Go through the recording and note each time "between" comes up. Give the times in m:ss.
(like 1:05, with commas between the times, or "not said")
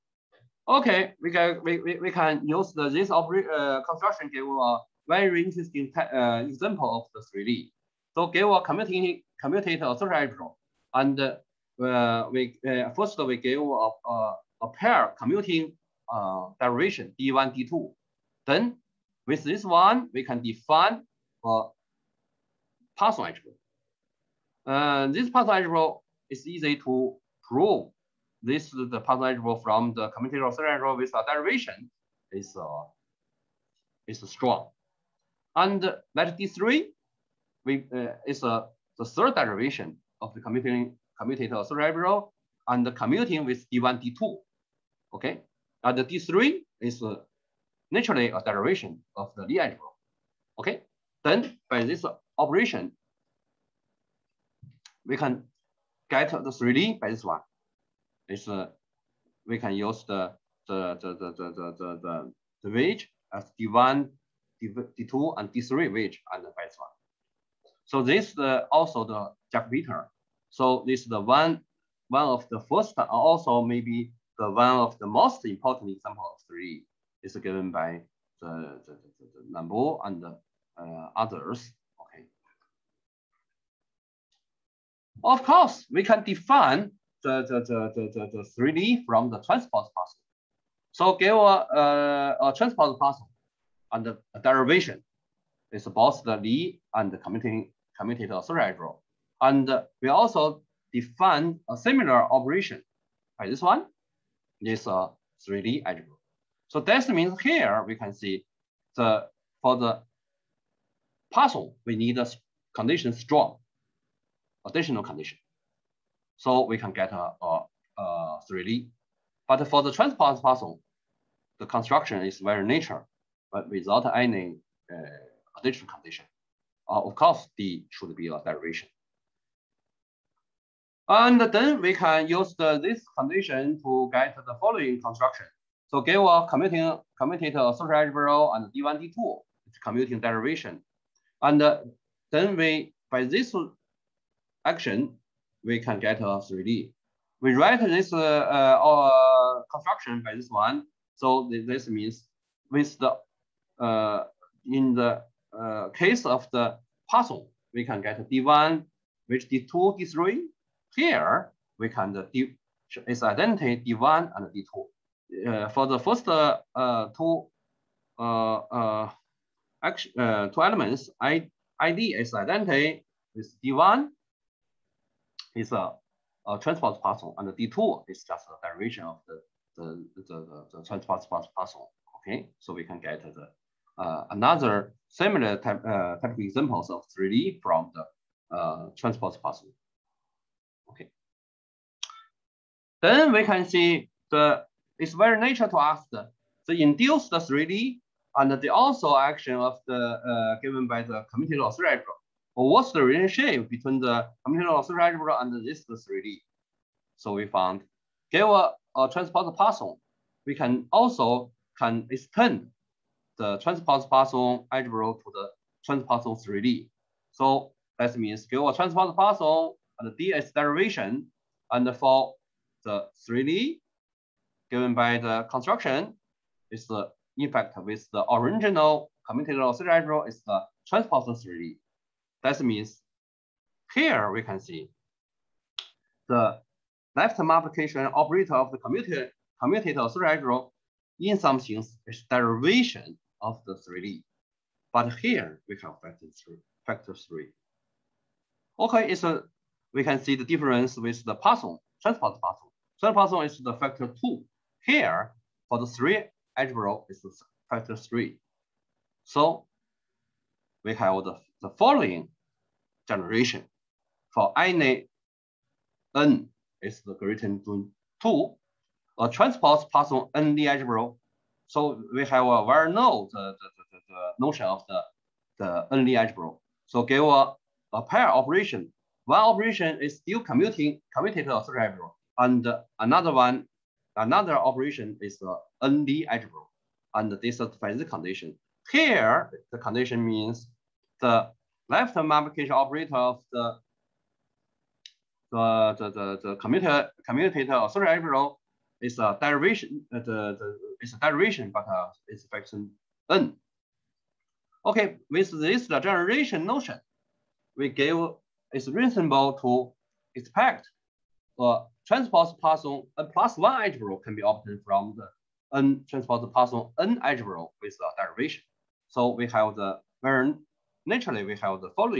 3:23.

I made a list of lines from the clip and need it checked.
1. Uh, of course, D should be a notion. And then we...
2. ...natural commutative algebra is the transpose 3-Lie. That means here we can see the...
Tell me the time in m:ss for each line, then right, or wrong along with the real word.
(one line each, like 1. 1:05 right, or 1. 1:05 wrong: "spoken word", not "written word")
1. 2:06 wrong: "derivation", not "notion"
2. 3:48 wrong: "original", not "natural".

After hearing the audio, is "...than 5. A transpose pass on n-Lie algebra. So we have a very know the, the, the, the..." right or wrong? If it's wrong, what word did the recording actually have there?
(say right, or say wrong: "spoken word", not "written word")
wrong: "2", not "5".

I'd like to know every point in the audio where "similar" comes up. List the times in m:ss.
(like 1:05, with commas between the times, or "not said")
1:41, 3:05.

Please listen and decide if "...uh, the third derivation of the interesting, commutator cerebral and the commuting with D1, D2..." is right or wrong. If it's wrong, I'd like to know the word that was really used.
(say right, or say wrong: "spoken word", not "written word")
wrong: "commuting", not "interesting".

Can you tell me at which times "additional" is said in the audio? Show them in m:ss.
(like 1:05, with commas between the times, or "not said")
1:54, 2:05.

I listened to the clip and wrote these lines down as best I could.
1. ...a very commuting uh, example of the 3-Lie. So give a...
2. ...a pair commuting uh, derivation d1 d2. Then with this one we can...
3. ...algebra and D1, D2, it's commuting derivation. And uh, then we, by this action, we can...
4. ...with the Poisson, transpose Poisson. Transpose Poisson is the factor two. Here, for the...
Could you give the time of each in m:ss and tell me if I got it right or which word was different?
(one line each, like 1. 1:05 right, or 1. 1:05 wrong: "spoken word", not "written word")
1. 0:04 wrong: "interesting", not "commuting"
2. 0:14 right
3. 2:17 right
4. 4:10 right.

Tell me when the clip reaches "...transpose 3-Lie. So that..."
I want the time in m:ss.
3:35.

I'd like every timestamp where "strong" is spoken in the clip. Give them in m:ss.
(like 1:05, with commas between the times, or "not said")
0:34, 1:53.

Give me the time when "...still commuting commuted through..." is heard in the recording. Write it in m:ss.
4:40.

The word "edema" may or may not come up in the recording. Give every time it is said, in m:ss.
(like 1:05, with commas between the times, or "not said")
not said.